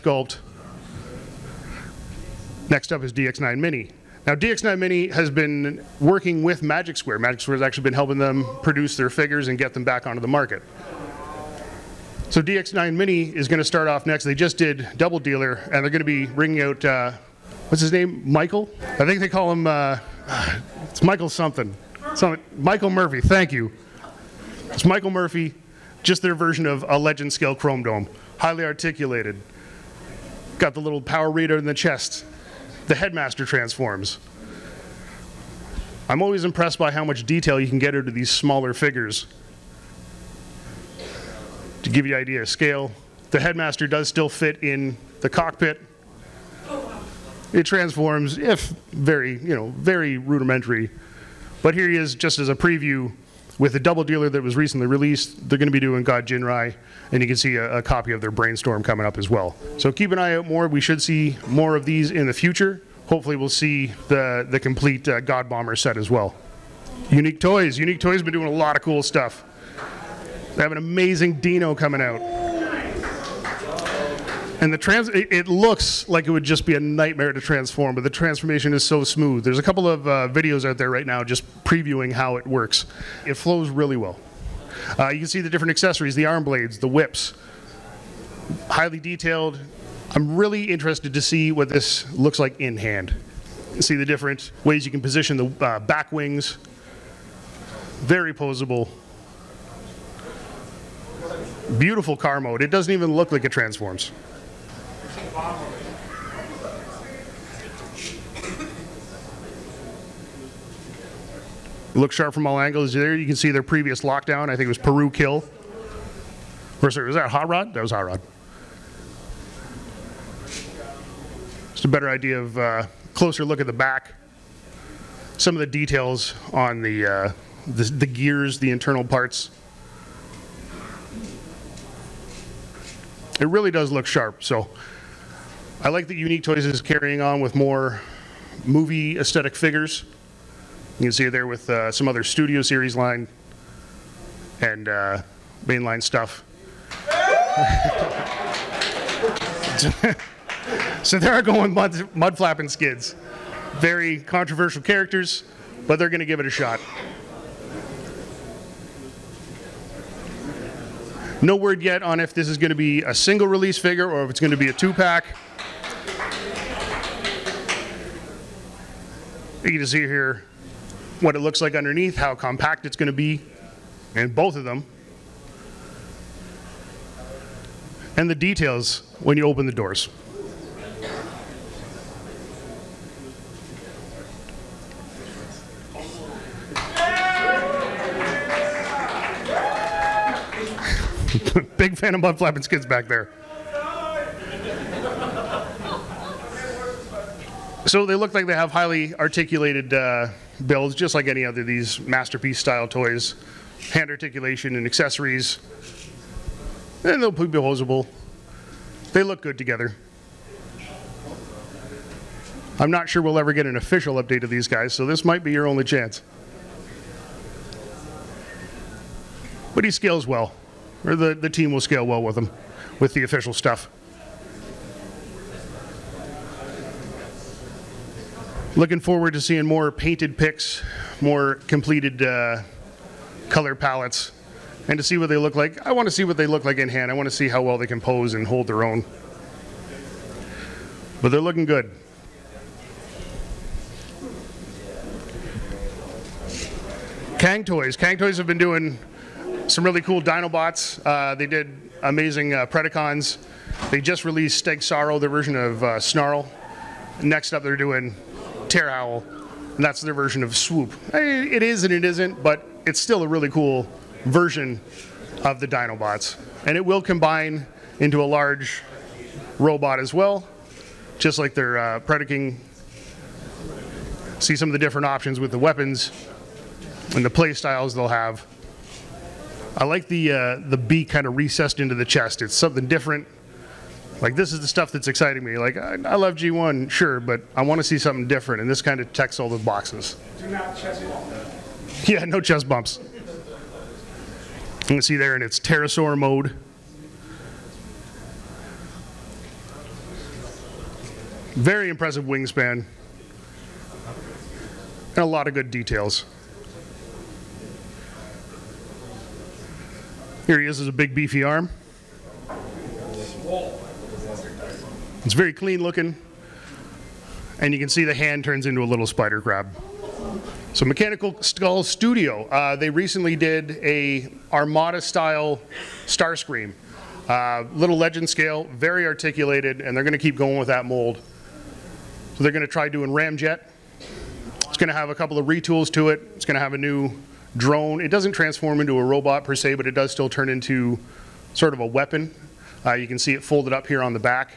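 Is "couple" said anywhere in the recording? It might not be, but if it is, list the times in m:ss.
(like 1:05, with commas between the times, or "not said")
1:19, 5:35.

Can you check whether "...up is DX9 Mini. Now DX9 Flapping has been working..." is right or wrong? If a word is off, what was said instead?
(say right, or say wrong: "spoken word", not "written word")
wrong: "Mini", not "Flapping".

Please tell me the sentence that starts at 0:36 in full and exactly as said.
I'm always impressed by how much detail you can get into these smaller figures.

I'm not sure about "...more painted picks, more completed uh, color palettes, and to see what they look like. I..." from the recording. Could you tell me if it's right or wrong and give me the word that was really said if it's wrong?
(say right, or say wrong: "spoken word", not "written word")
right.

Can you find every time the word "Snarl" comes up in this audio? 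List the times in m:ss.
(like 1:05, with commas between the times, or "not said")
4:15.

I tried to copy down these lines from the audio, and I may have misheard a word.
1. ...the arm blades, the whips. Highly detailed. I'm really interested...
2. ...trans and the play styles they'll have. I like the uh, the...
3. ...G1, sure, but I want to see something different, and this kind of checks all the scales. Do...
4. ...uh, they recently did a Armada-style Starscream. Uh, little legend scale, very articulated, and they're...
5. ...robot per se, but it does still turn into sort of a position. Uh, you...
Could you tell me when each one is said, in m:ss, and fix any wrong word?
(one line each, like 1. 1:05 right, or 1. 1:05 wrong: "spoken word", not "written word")
1. 1:26 right
2. 4:35 wrong: "weapons", not "trans"
3. 4:46 wrong: "boxes", not "scales"
4. 5:22 right
5. 5:39 wrong: "weapon", not "position".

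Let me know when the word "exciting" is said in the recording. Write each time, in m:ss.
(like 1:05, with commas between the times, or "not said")
4:45.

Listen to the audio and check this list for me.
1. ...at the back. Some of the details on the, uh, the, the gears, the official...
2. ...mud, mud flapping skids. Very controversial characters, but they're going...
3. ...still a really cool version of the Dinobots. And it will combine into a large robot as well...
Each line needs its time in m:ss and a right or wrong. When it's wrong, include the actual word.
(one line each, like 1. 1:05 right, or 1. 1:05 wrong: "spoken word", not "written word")
1. 2:03 wrong: "internal", not "official"
2. 2:31 right
3. 4:23 right.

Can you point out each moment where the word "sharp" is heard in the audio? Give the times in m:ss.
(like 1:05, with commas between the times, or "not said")
1:52, 2:14.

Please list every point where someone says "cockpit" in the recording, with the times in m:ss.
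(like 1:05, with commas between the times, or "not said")
0:45.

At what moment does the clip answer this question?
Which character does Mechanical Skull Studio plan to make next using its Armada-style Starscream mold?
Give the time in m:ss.
5:33.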